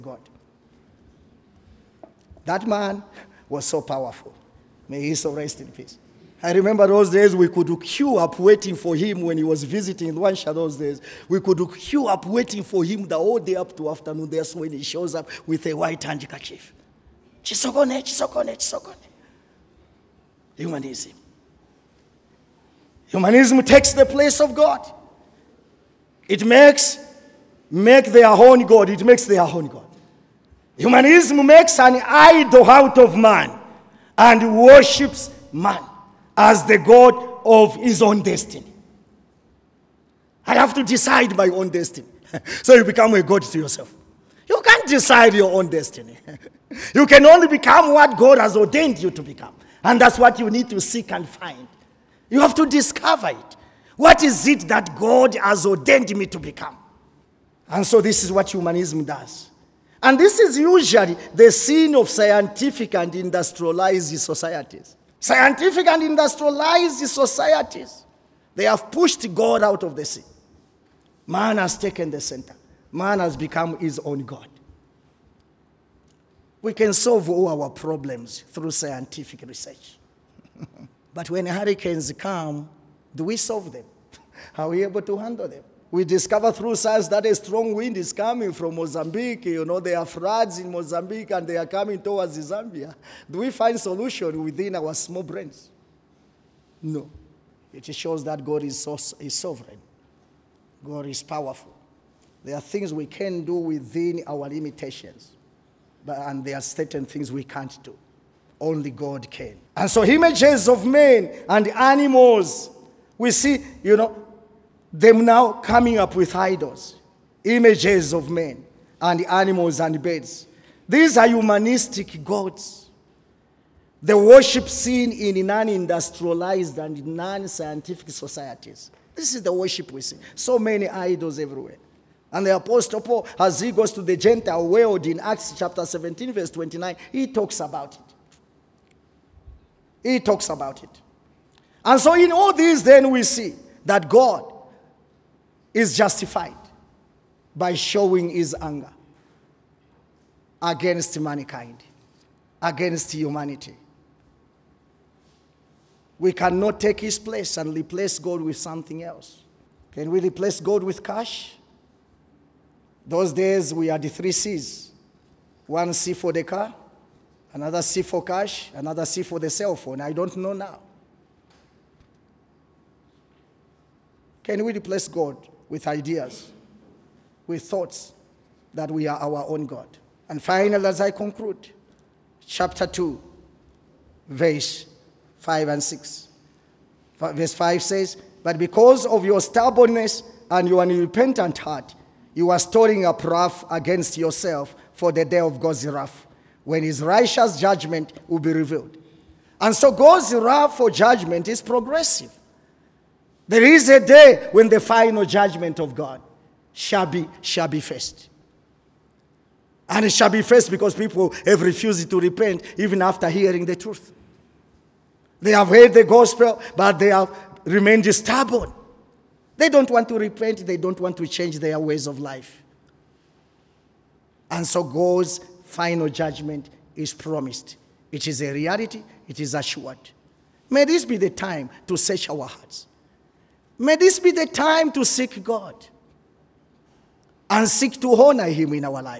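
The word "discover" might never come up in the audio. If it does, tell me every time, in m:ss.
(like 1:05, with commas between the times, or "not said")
0:52, 1:26.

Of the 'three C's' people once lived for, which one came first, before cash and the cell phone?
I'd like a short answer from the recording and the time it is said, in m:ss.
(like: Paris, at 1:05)
car, at 2:46.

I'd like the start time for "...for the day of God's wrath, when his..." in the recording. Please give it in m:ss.
3:14.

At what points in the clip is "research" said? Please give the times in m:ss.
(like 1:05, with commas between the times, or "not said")
1:19.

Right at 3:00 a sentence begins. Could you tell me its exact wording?
And finally, as I conclude, chapter 2, verse 5 and 6.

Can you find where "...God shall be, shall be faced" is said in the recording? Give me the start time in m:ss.
3:25.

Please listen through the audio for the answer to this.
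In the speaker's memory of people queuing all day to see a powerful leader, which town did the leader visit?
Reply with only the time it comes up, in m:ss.
0:10.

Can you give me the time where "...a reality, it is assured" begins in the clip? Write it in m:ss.
3:48.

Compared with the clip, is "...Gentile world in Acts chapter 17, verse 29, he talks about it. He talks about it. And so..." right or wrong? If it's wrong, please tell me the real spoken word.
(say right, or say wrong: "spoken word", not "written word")
right.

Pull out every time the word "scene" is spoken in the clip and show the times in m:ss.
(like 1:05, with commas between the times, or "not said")
1:01, 1:10.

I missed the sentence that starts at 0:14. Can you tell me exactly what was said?
That's when he shows up with a white handkerchief.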